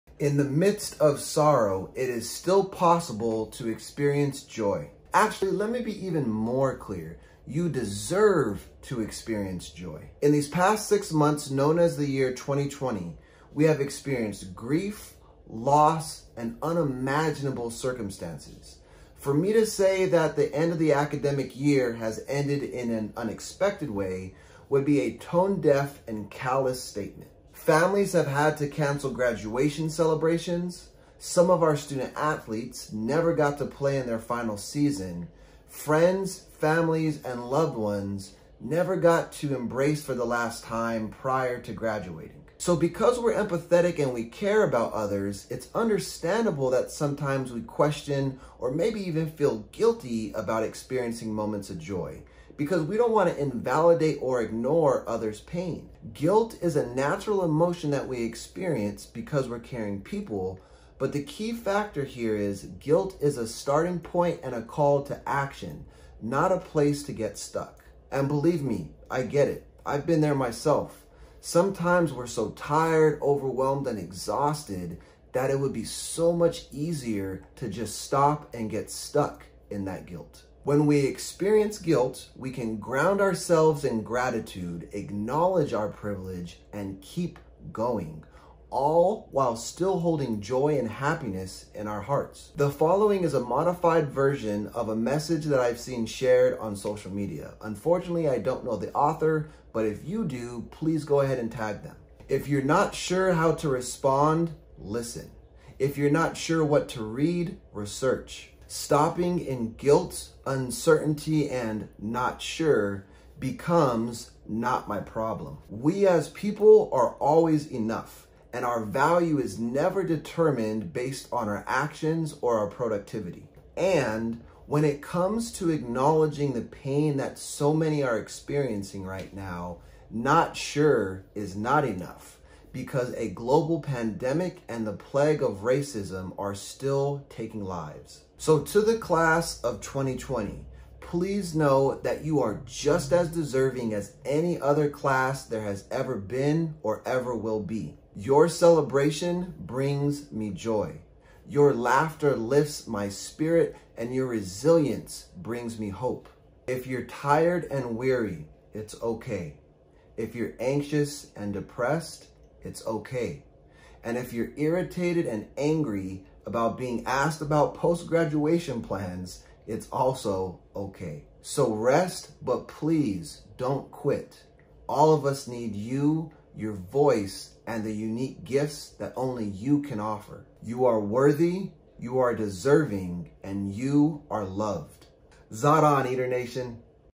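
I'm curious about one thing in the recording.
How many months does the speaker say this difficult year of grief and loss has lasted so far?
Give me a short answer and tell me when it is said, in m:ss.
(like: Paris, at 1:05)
6, at 0:10.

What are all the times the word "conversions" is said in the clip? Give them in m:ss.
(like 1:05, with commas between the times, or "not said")
not said.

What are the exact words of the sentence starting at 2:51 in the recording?
So rest, but please don't quit.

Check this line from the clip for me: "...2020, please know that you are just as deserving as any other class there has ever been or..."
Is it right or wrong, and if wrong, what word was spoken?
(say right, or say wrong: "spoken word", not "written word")
right.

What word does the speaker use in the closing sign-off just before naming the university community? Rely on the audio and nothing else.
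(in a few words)
Zot.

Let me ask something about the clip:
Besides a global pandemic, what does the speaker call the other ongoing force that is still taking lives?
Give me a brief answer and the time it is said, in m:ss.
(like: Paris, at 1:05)
the plague of racism, at 2:14.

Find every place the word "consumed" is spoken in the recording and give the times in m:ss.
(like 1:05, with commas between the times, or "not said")
not said.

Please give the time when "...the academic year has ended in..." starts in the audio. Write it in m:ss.
0:20.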